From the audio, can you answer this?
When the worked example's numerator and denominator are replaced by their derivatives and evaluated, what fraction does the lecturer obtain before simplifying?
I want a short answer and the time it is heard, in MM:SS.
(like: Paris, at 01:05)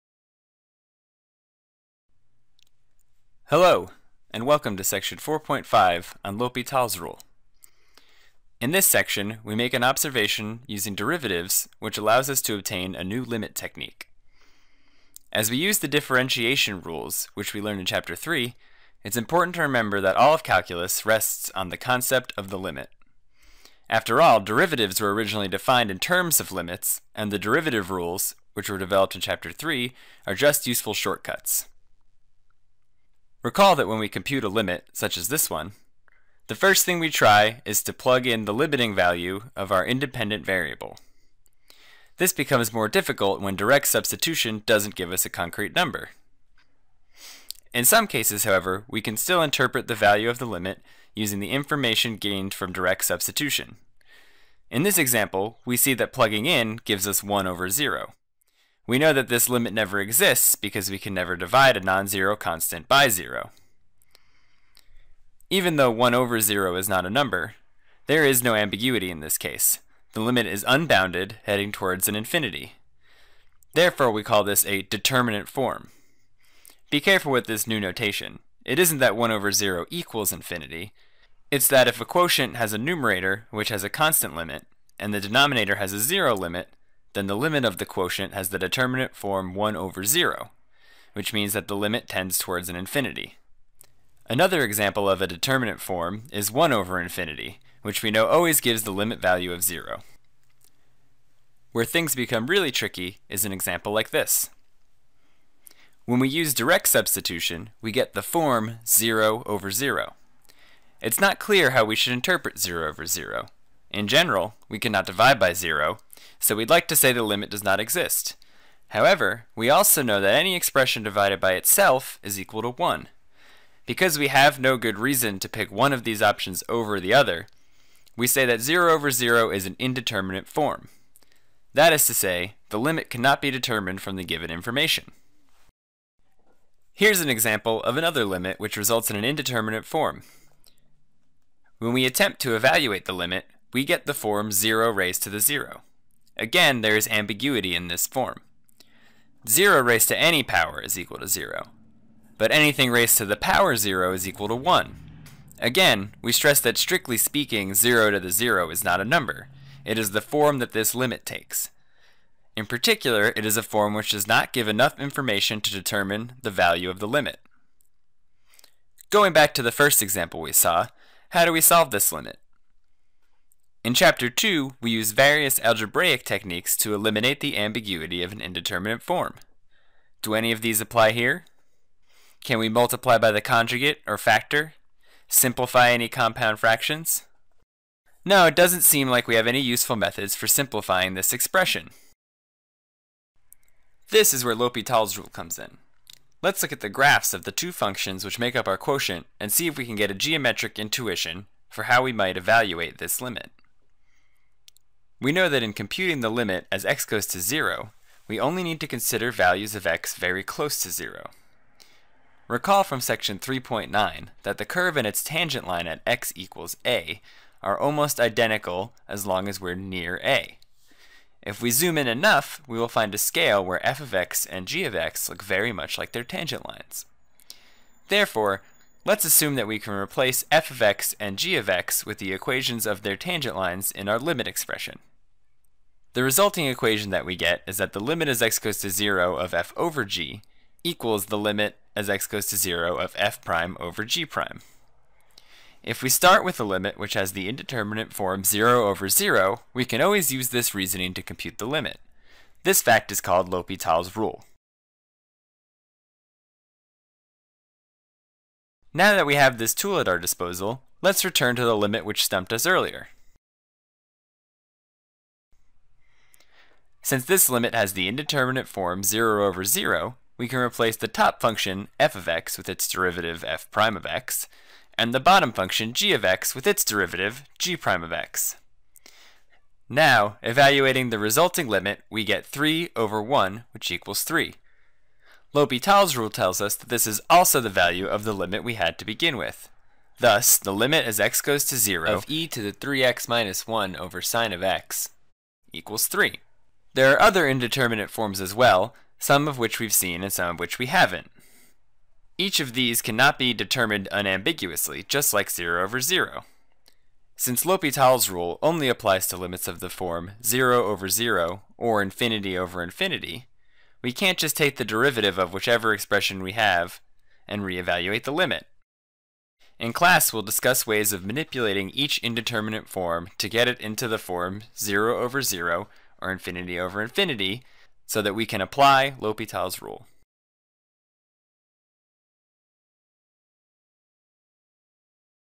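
3 over 1, at 04:42.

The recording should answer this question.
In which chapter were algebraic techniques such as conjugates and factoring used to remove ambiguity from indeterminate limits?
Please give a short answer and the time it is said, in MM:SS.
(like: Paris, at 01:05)
Chapter 2, at 02:53.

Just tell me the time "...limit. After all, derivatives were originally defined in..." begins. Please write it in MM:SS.
00:22.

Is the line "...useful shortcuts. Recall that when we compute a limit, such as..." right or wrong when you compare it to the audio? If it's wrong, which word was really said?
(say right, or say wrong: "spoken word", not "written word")
right.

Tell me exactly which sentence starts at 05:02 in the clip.
Each of these cannot be determined unambiguously, just like 0 over 0.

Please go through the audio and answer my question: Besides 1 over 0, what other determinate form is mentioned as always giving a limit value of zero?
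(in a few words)
1 over infinity.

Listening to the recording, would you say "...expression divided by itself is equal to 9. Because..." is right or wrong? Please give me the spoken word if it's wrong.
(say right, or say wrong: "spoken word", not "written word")
wrong: "1", not "9".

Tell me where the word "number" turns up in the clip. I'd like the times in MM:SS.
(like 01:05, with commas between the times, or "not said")
00:45, 01:07, 02:39.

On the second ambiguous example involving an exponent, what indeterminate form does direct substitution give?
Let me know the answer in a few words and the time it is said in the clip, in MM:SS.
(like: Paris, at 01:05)
0 raised to the 0, at 02:24.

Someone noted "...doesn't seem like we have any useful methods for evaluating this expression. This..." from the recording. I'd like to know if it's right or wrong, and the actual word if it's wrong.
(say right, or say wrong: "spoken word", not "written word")
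wrong: "simplifying", not "evaluating".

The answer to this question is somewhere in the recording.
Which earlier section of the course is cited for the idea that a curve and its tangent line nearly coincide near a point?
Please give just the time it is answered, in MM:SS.
03:33.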